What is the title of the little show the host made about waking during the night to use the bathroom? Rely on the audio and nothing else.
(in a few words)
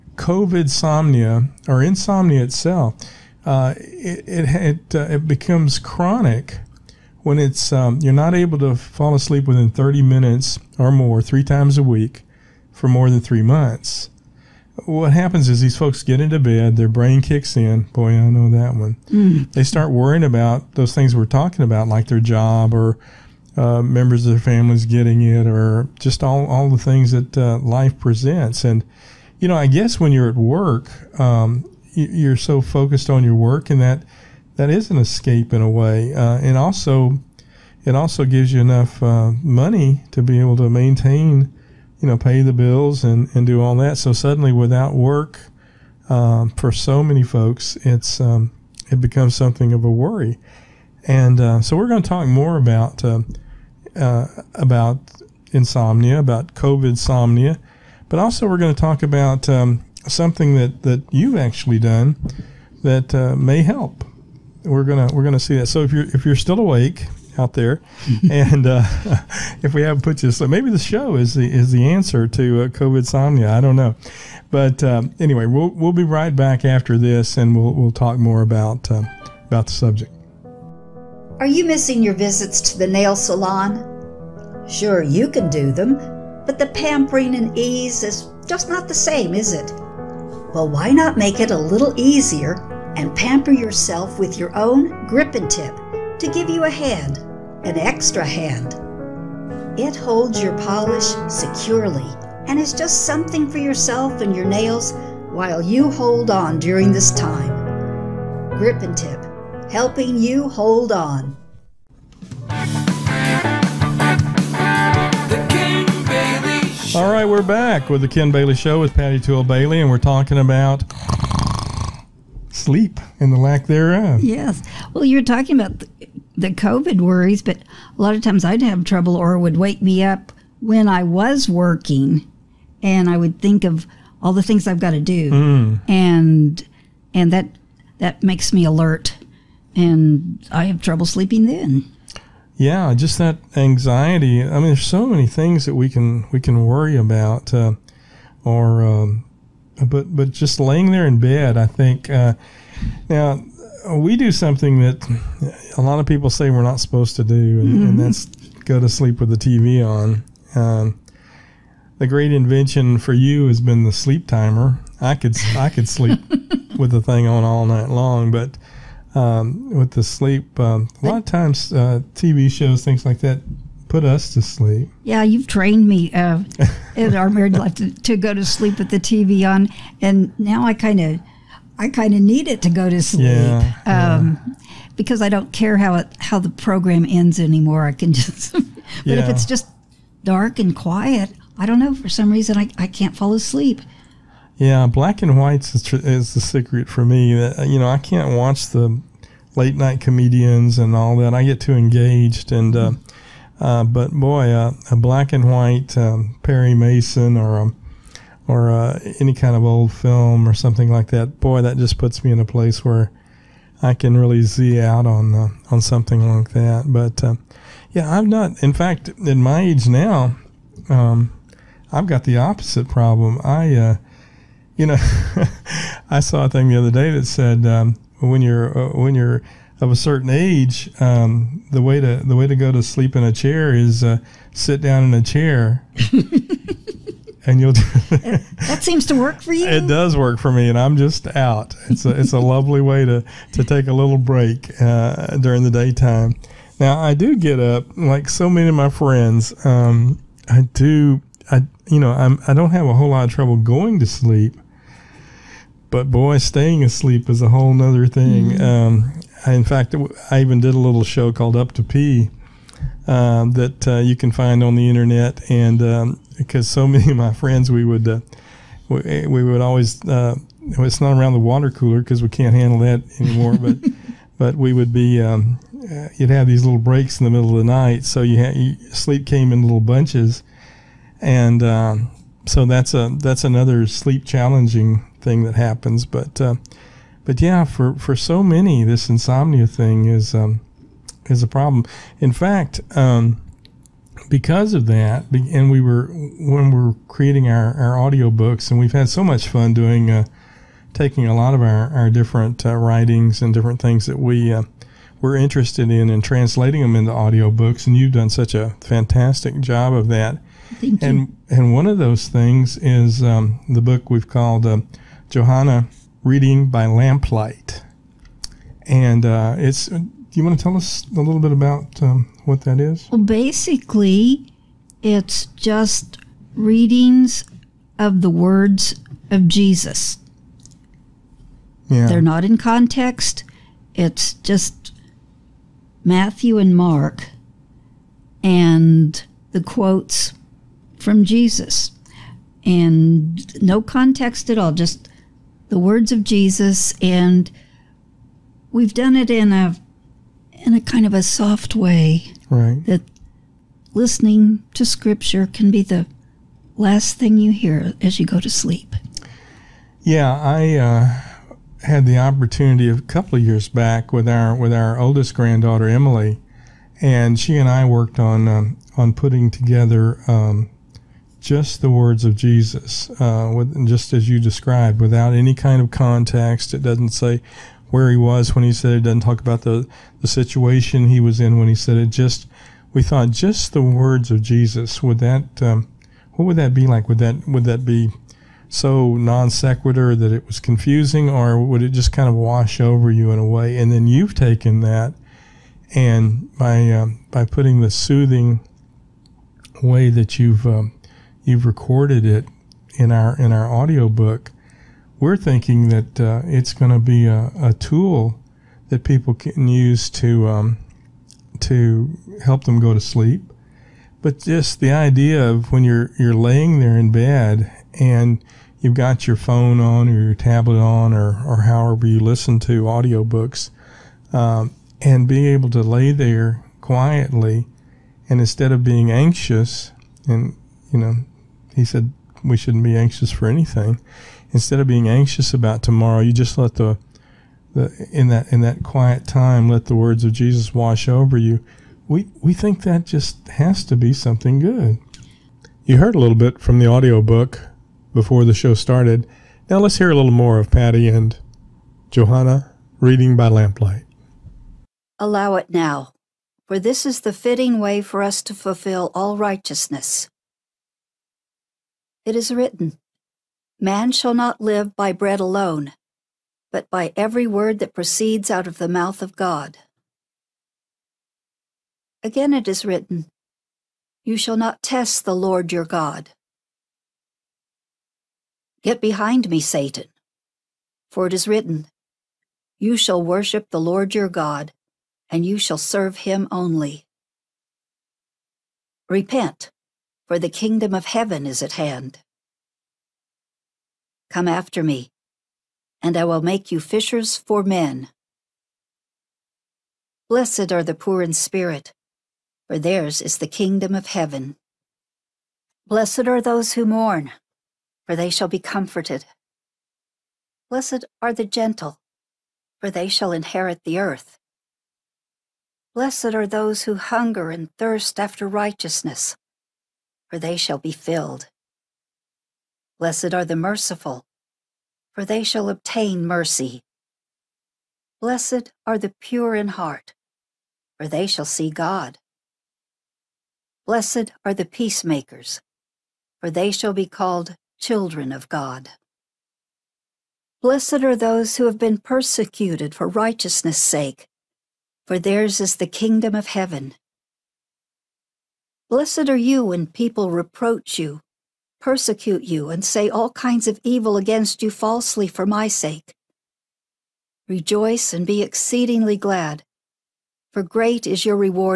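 Up to Pee.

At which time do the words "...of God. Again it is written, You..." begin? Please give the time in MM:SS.
07:49.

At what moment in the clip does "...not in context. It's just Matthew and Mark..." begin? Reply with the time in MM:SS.
05:32.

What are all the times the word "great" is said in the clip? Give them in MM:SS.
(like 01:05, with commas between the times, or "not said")
02:42, 09:20.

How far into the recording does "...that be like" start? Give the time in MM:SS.
06:26.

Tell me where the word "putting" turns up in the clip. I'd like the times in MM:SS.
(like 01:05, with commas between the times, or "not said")
06:09, 06:37.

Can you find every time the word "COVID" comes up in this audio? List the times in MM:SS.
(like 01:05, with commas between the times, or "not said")
00:00, 00:56, 01:12, 02:06.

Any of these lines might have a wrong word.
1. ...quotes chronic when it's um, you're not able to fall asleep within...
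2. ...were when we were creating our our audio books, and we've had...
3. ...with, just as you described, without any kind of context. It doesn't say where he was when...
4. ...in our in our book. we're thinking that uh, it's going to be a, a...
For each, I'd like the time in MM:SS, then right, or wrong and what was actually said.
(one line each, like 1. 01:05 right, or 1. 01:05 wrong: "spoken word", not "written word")
1. 00:05 wrong: "becomes", not "quotes"
2. 04:55 right
3. 06:13 right
4. 06:42 right.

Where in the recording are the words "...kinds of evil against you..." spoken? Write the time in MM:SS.
09:13.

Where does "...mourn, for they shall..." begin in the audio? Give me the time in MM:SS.
08:26.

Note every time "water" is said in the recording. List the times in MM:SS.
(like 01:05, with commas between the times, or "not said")
04:31.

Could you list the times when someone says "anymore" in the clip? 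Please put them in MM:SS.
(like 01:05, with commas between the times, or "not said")
03:07, 04:33.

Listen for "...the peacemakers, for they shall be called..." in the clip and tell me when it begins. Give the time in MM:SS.
08:54.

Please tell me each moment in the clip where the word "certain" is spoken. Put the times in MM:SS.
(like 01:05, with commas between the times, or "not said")
03:49.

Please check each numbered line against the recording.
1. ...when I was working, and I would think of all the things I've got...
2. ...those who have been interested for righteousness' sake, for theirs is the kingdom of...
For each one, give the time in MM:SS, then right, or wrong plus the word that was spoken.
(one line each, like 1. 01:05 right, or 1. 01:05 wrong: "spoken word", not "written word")
1. 02:10 right
2. 09:01 wrong: "persecuted", not "interested".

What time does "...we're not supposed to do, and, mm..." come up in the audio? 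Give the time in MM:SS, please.
02:36.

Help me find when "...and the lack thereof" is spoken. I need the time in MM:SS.
02:03.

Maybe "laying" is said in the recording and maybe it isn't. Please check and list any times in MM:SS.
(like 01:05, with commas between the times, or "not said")
02:30, 06:56.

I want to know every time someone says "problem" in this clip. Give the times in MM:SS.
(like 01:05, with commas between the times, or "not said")
03:42, 04:51.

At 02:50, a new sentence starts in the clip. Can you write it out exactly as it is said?
Um, a lot of times, uh, TV shows, things like that, put us to sleep.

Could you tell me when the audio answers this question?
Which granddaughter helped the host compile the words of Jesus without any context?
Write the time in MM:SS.
06:05.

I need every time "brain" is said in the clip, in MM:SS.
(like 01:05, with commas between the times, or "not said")
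00:16.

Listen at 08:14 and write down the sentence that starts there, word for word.
Come after me, and I will make you fishers for men.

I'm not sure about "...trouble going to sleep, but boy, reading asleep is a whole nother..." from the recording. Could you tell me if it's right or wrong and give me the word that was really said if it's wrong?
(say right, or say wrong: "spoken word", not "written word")
wrong: "staying", not "reading".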